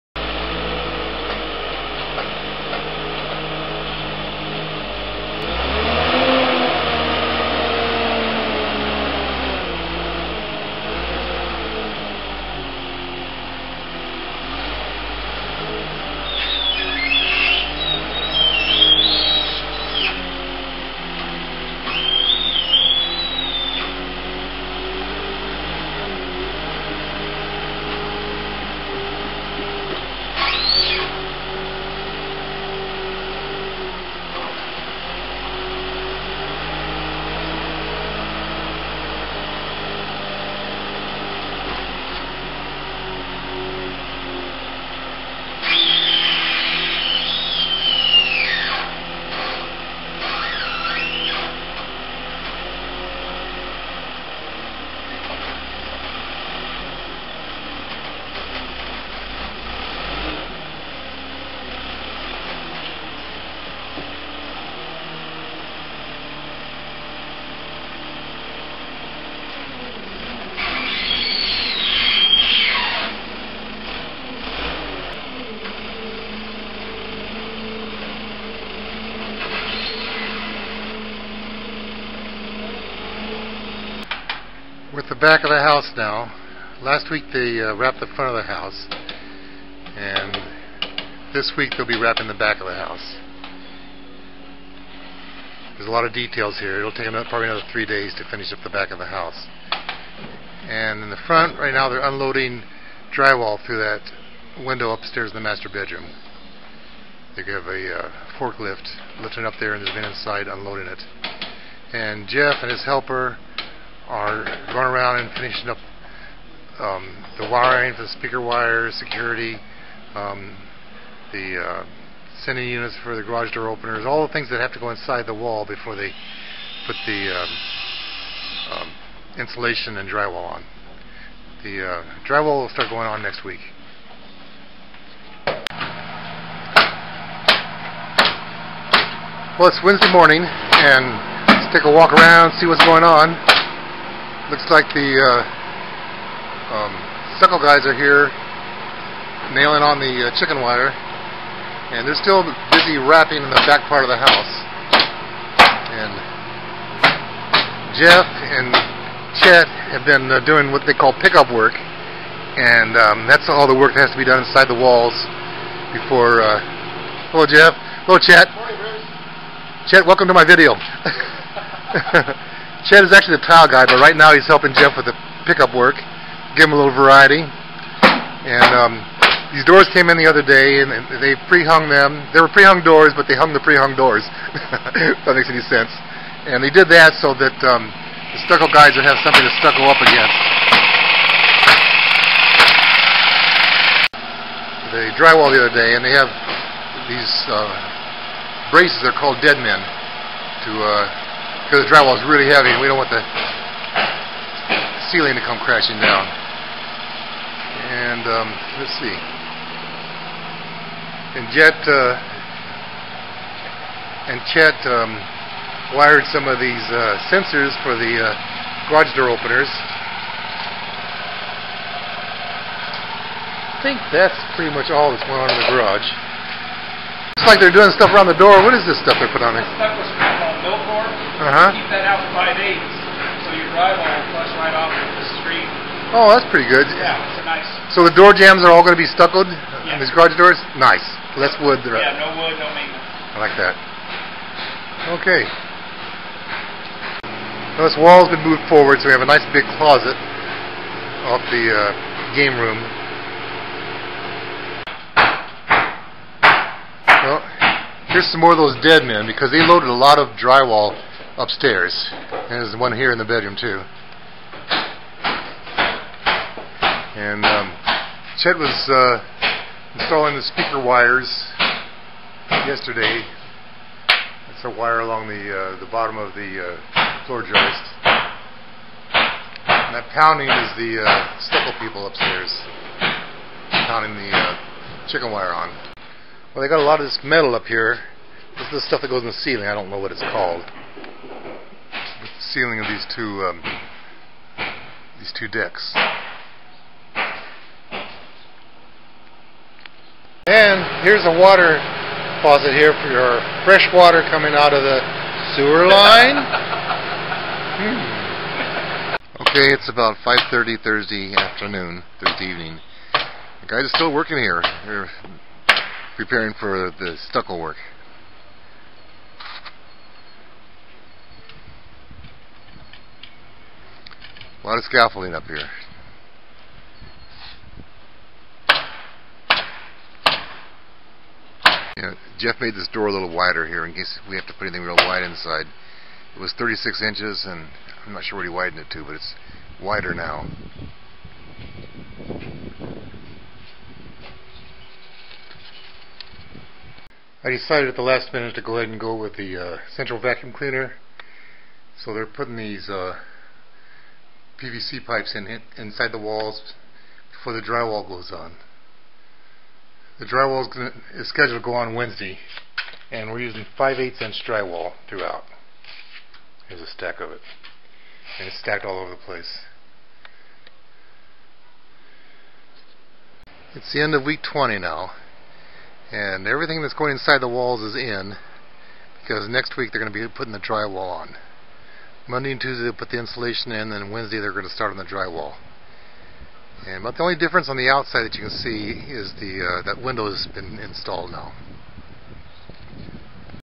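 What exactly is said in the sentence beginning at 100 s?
And in the front, right now they're unloading drywall through that window upstairs in the master bedroom.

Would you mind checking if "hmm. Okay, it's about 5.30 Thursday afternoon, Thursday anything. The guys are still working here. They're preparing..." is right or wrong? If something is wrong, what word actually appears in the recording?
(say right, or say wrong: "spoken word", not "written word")
wrong: "evening", not "anything".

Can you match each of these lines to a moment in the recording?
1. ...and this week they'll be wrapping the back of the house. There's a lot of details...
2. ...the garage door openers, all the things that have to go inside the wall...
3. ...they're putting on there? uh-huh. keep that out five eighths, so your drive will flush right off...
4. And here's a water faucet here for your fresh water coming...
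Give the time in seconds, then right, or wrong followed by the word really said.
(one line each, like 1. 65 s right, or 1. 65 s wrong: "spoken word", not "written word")
1. 89 s right
2. 123 s right
3. 229 s right
4. 300 s right.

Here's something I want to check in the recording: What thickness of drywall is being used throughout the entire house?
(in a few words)
5/8 inch.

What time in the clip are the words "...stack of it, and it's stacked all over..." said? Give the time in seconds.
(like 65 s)
366 s.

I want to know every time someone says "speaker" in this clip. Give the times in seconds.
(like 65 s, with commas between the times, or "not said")
118 s, 270 s.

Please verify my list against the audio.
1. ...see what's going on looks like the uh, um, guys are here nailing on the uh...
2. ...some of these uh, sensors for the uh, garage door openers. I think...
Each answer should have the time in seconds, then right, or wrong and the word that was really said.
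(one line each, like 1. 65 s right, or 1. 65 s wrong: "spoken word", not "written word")
1. 142 s right
2. 216 s right.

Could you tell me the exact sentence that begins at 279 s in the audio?
And that pounding is the uh, stucco people upstairs pounding the uh, chicken wire on.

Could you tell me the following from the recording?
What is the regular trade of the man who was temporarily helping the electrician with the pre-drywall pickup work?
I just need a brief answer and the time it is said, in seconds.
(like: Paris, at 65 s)
Tile guy, at 173 s.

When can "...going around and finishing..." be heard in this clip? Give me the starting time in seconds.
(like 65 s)
114 s.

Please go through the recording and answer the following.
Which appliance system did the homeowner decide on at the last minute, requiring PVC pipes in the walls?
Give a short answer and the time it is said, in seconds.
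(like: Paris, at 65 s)
Central vacuum cleaner, at 349 s.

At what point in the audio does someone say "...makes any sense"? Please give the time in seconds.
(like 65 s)
185 s.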